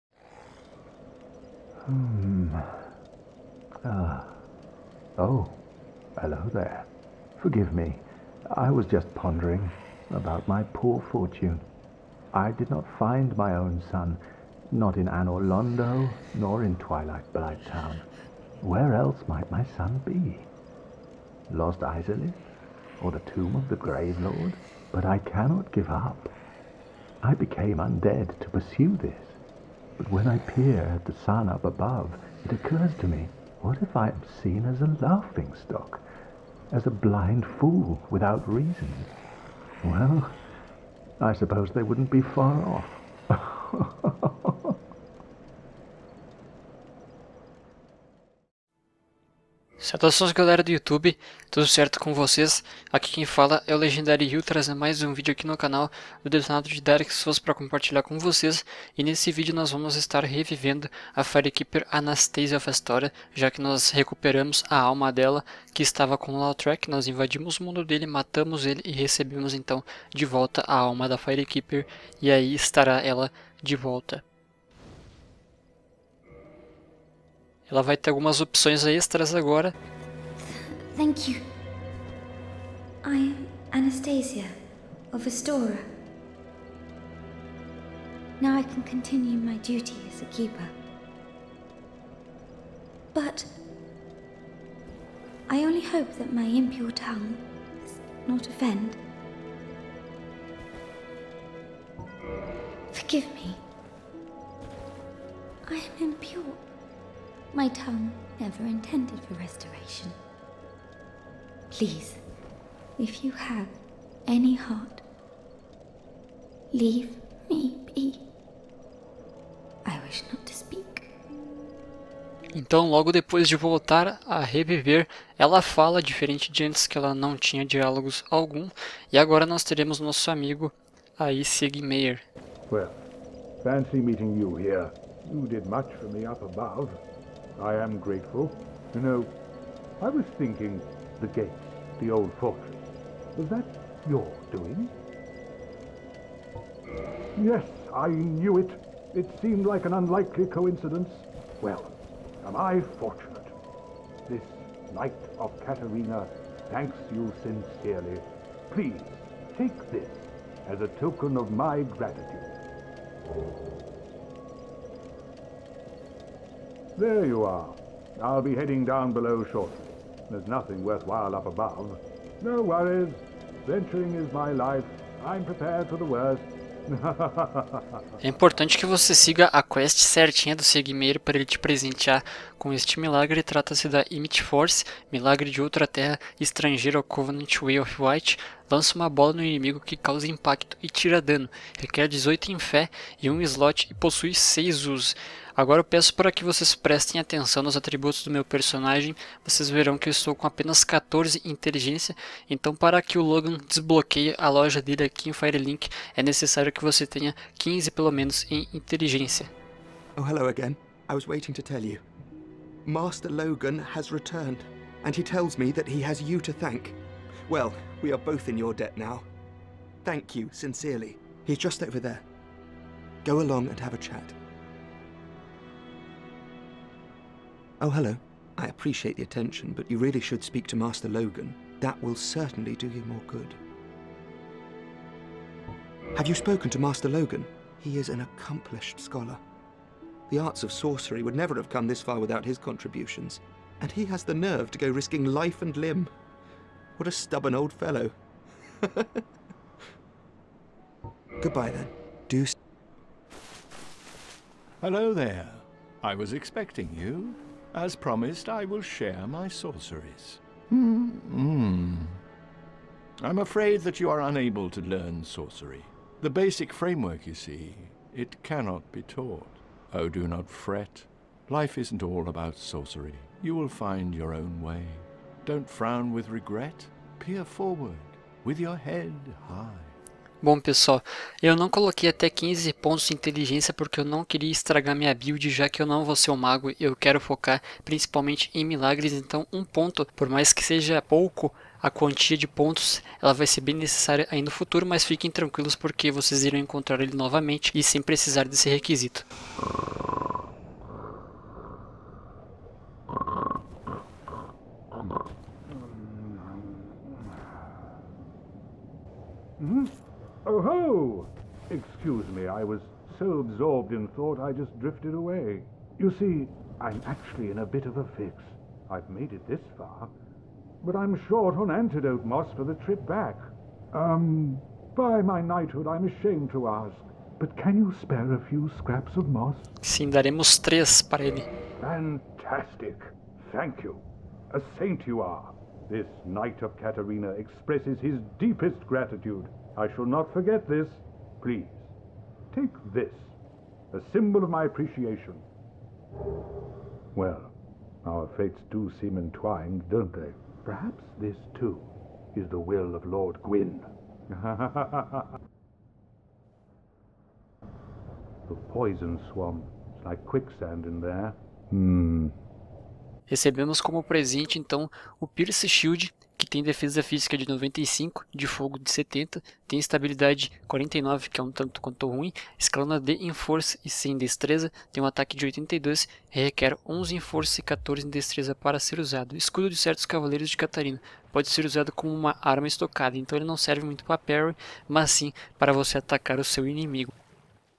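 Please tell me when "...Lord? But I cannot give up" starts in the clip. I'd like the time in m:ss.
0:24.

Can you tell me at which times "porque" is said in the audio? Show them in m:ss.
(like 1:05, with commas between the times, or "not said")
4:43, 4:55.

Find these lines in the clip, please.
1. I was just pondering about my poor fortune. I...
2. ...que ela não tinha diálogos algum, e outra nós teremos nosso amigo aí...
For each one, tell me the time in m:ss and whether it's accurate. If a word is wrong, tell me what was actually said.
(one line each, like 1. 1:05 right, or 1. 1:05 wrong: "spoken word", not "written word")
1. 0:08 right
2. 2:06 wrong: "agora", not "outra".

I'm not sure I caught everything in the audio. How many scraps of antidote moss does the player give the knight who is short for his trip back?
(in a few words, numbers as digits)
3.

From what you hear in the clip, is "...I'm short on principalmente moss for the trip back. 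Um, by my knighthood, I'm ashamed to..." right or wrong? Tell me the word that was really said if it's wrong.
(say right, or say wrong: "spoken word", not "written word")
wrong: "antidote", not "principalmente".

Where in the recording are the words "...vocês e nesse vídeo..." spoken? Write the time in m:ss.
0:58.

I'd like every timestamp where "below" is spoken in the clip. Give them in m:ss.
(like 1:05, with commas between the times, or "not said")
2:49.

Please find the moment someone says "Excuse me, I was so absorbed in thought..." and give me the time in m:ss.
5:11.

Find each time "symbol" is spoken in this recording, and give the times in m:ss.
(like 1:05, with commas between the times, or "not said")
5:44.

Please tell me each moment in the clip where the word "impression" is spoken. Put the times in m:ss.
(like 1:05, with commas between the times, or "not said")
not said.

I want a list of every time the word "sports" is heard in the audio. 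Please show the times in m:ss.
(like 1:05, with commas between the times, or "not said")
not said.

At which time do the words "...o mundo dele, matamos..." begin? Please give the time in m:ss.
1:07.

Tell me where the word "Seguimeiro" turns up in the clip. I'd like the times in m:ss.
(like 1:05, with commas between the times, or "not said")
3:00.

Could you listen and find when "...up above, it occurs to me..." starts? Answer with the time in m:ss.
0:31.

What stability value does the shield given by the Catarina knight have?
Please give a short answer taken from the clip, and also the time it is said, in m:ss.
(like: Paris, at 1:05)
49, at 6:09.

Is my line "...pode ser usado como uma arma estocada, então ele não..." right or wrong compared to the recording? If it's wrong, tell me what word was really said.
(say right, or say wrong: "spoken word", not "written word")
right.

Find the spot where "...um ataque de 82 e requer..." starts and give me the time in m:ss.
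6:15.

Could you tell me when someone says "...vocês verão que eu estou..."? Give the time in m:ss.
3:19.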